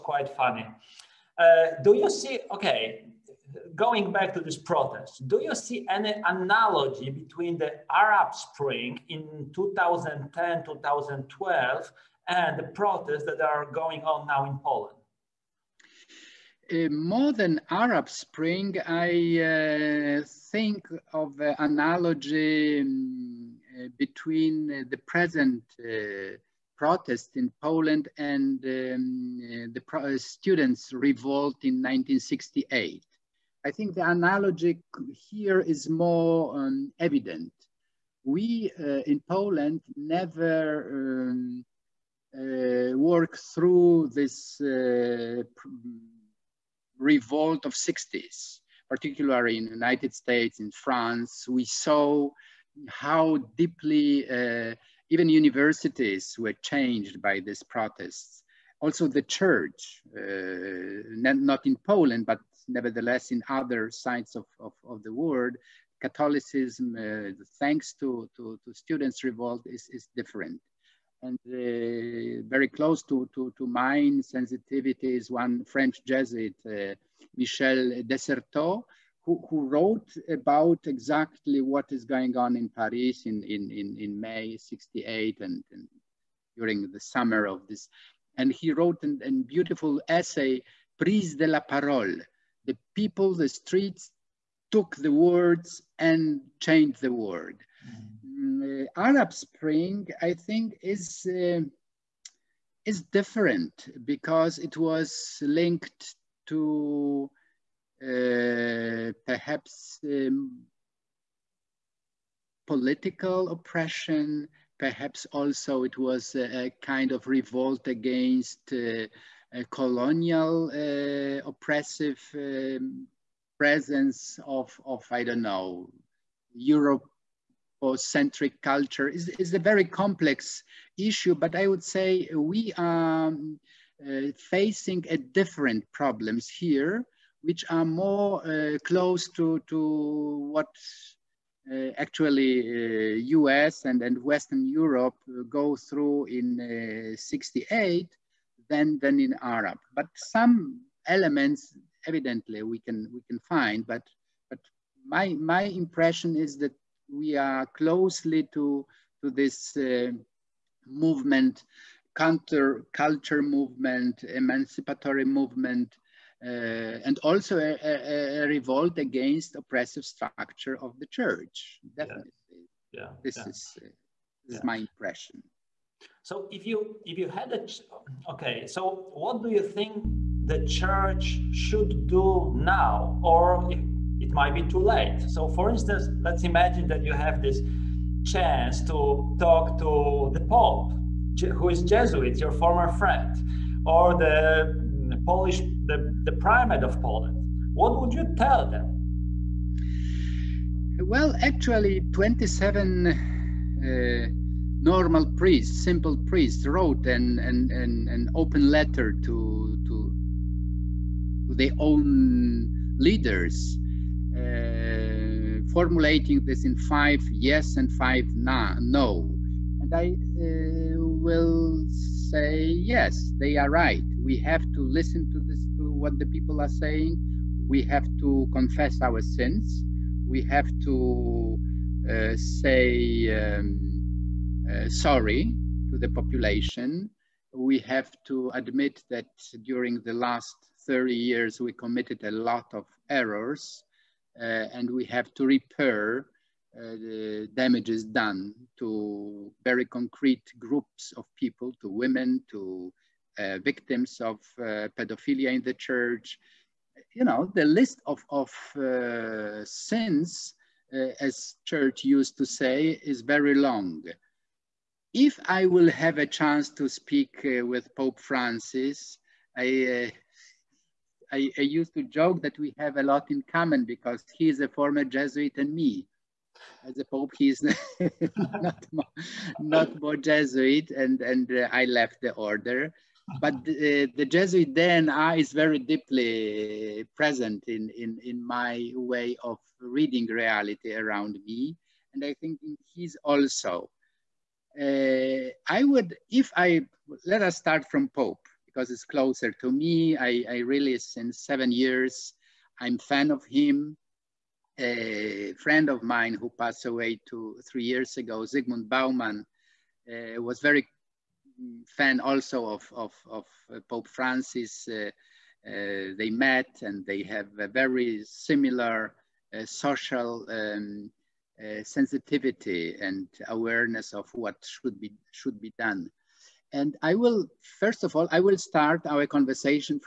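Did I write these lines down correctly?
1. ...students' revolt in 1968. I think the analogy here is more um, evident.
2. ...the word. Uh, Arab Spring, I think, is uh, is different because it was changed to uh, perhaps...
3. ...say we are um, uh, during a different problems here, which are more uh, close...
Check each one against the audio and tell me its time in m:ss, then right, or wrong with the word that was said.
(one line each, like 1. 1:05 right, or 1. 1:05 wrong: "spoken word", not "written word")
1. 0:30 right
2. 1:36 wrong: "linked", not "changed"
3. 2:11 wrong: "facing", not "during".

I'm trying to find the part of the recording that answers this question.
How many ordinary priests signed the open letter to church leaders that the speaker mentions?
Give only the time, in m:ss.
3:22.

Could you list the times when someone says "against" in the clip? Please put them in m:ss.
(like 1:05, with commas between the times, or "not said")
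1:57, 2:48.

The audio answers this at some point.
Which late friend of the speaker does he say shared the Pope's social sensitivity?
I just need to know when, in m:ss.
5:08.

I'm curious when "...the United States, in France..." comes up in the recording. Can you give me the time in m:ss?
0:49.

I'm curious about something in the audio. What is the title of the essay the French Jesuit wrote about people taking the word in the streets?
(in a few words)
Prise de la Parole.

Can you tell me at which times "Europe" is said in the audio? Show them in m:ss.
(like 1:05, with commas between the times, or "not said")
2:06, 2:24.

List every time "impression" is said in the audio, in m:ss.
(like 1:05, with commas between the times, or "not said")
2:35, 2:54.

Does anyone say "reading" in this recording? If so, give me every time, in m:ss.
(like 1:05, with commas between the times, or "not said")
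4:49.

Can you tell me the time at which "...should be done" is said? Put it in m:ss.
5:25.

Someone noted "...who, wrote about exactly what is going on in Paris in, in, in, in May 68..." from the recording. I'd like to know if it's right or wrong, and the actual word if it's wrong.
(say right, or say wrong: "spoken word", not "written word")
right.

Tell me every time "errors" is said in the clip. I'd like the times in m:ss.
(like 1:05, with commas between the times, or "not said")
4:03.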